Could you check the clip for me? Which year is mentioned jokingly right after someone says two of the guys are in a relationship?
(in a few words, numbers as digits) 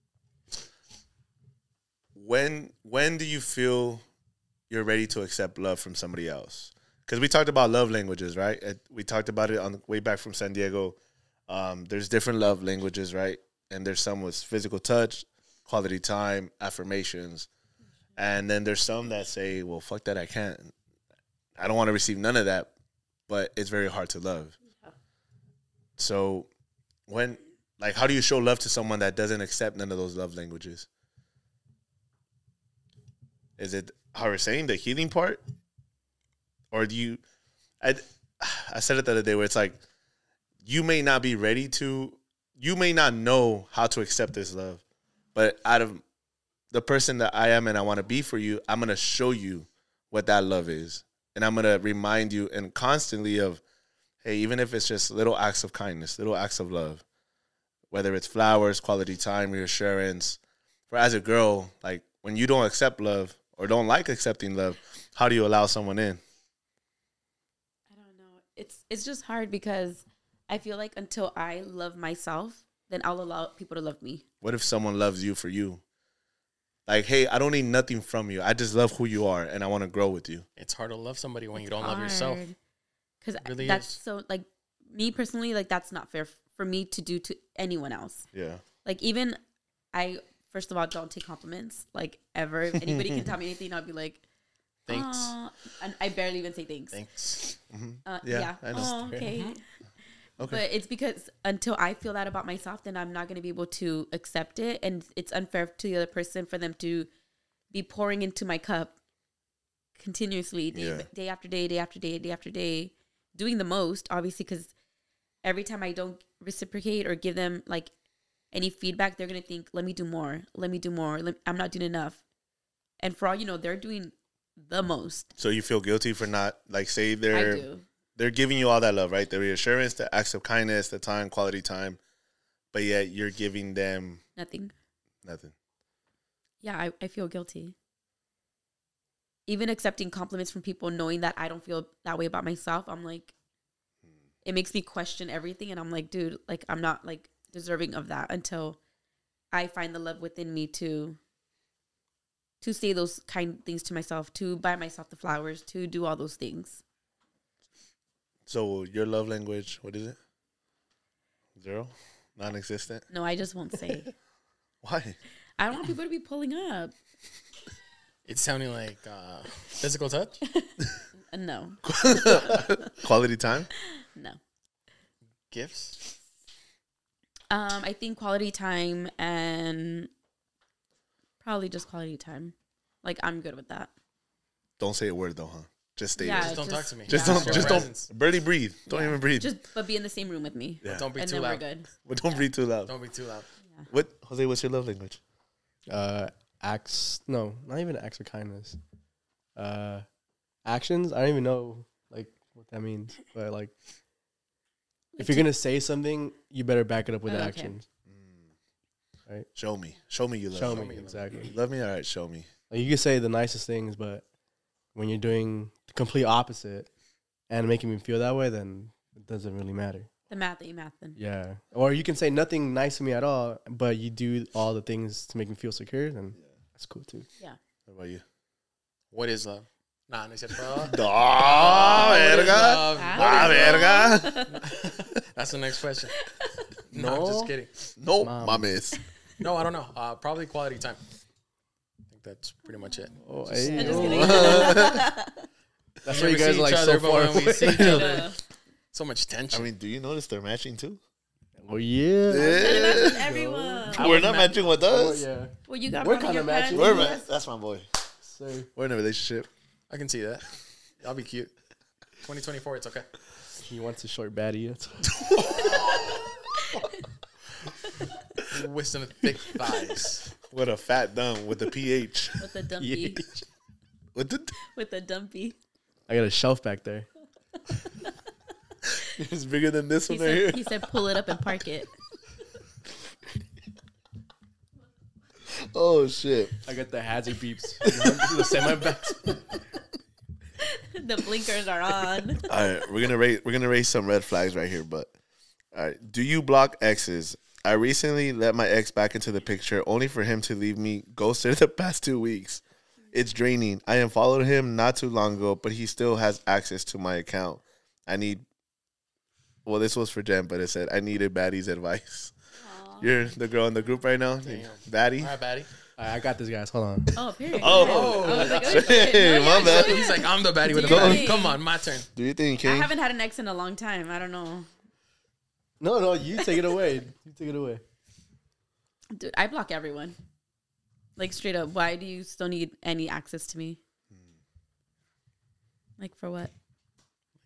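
2024.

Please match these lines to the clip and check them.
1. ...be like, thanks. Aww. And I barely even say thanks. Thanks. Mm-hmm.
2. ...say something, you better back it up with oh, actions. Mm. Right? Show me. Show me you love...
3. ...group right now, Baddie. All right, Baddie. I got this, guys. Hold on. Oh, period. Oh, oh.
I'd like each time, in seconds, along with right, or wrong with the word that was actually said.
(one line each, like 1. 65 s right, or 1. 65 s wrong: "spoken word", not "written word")
1. 93 s right
2. 205 s right
3. 313 s right.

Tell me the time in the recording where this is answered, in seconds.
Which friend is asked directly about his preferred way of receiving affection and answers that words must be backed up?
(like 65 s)
194 s.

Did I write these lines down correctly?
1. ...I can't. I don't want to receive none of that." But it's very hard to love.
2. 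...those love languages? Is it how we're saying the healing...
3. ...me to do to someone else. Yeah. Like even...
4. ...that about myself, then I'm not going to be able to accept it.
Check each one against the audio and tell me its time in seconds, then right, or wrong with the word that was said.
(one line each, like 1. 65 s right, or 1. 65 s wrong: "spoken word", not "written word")
1. 20 s right
2. 29 s right
3. 86 s wrong: "anyone", not "someone"
4. 102 s right.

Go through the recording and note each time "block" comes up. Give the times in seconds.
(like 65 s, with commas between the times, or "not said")
296 s, 329 s.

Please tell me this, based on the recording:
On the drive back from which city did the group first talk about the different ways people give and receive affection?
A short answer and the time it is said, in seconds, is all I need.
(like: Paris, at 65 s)
San Diego, at 10 s.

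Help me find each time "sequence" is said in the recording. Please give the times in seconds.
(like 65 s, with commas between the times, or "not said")
not said.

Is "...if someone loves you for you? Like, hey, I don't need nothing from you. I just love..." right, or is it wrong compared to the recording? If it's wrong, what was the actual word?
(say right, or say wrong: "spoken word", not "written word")
right.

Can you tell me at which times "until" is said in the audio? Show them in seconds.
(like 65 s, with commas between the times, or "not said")
70 s, 101 s, 148 s.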